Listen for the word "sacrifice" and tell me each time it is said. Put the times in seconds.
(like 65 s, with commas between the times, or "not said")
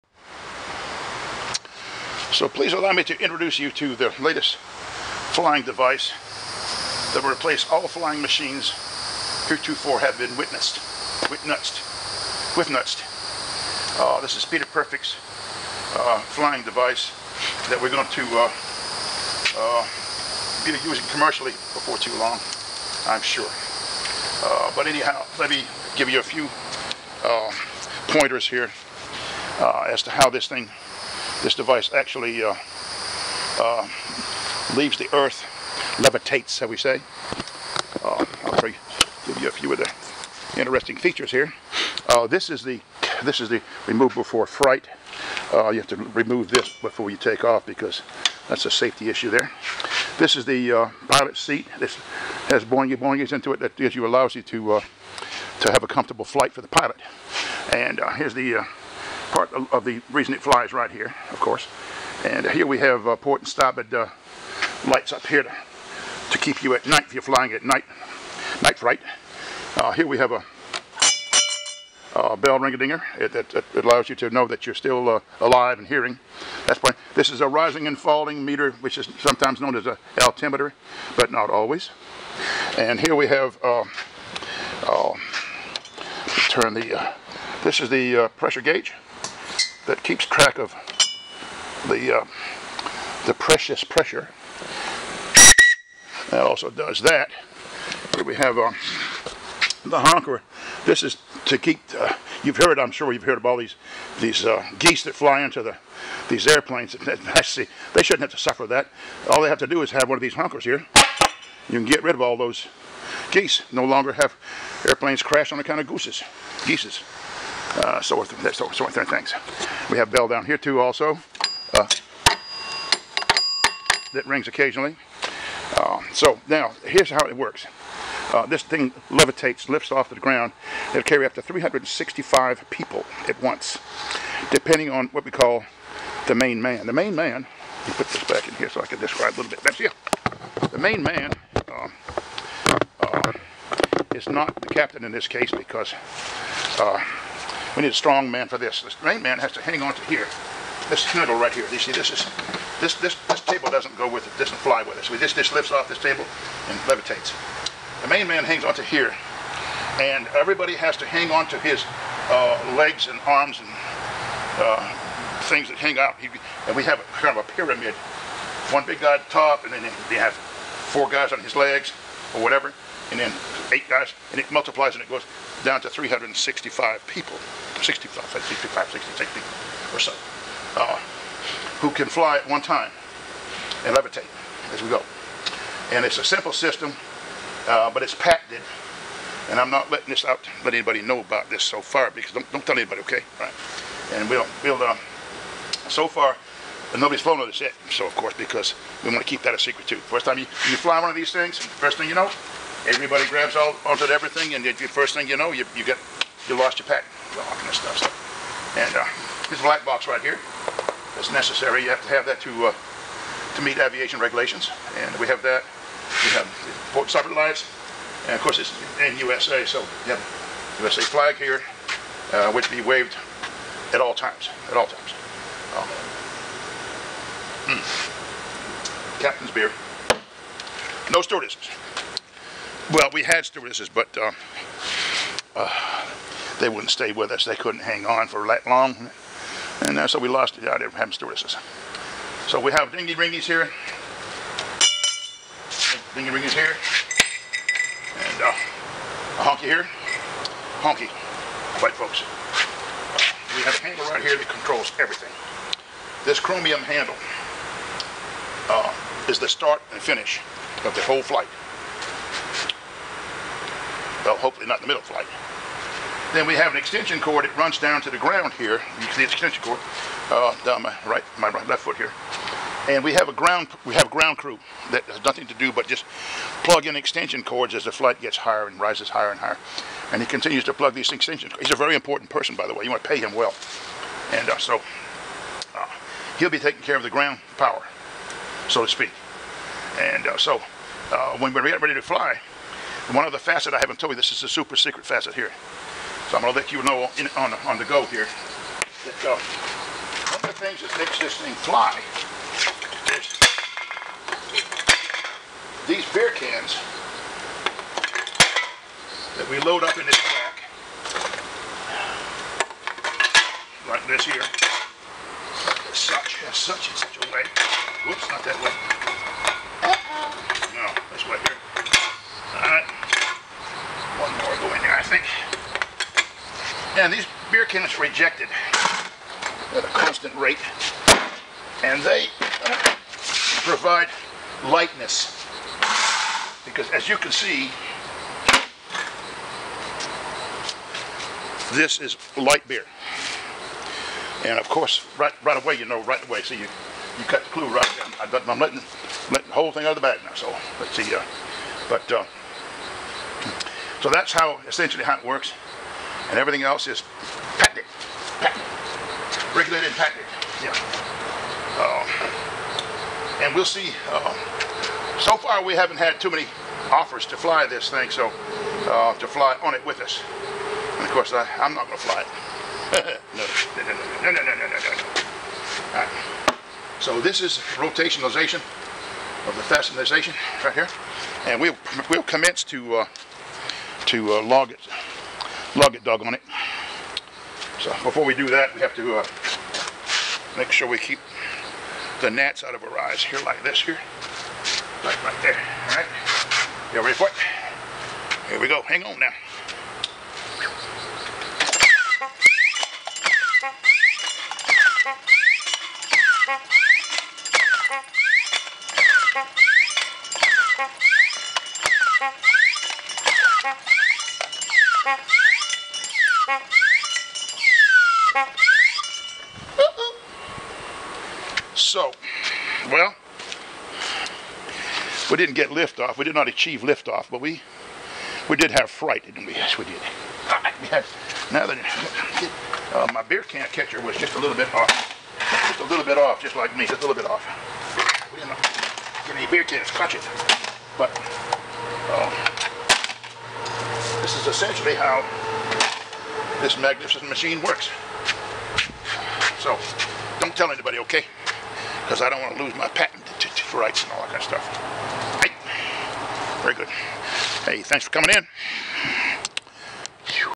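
not said.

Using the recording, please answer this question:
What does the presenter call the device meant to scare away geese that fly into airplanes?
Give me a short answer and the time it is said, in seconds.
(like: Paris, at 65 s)
The honker, at 99 s.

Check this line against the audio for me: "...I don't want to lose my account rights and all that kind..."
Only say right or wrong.
wrong.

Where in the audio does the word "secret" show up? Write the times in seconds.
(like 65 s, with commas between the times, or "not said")
199 s, 294 s.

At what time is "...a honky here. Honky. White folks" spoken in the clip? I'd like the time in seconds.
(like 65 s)
248 s.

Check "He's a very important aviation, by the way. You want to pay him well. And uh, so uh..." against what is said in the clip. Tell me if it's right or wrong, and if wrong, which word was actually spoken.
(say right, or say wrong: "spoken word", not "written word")
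wrong: "person", not "aviation".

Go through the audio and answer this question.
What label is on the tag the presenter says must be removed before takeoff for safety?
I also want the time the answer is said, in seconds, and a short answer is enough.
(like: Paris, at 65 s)
Remove before fright, at 43 s.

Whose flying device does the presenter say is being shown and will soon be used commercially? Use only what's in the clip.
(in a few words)
Peter Perfect.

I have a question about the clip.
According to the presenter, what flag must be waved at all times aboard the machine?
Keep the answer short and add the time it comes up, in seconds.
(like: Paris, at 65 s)
USA flag, at 220 s.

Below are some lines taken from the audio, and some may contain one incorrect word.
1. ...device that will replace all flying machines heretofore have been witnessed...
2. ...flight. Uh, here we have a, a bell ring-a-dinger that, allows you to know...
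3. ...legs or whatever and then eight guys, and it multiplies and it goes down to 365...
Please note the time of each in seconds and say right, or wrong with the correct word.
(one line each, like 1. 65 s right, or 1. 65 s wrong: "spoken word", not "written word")
1. 5 s right
2. 68 s right
3. 171 s right.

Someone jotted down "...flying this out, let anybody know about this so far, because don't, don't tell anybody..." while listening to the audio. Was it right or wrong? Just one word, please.
wrong.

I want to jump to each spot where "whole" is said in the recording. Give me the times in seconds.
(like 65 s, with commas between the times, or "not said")
261 s, 349 s.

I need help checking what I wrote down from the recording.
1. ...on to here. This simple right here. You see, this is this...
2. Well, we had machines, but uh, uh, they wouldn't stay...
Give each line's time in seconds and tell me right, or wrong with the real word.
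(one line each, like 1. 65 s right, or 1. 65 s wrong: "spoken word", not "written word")
1. 149 s wrong: "handle", not "simple"
2. 232 s wrong: "stewardesses", not "machines".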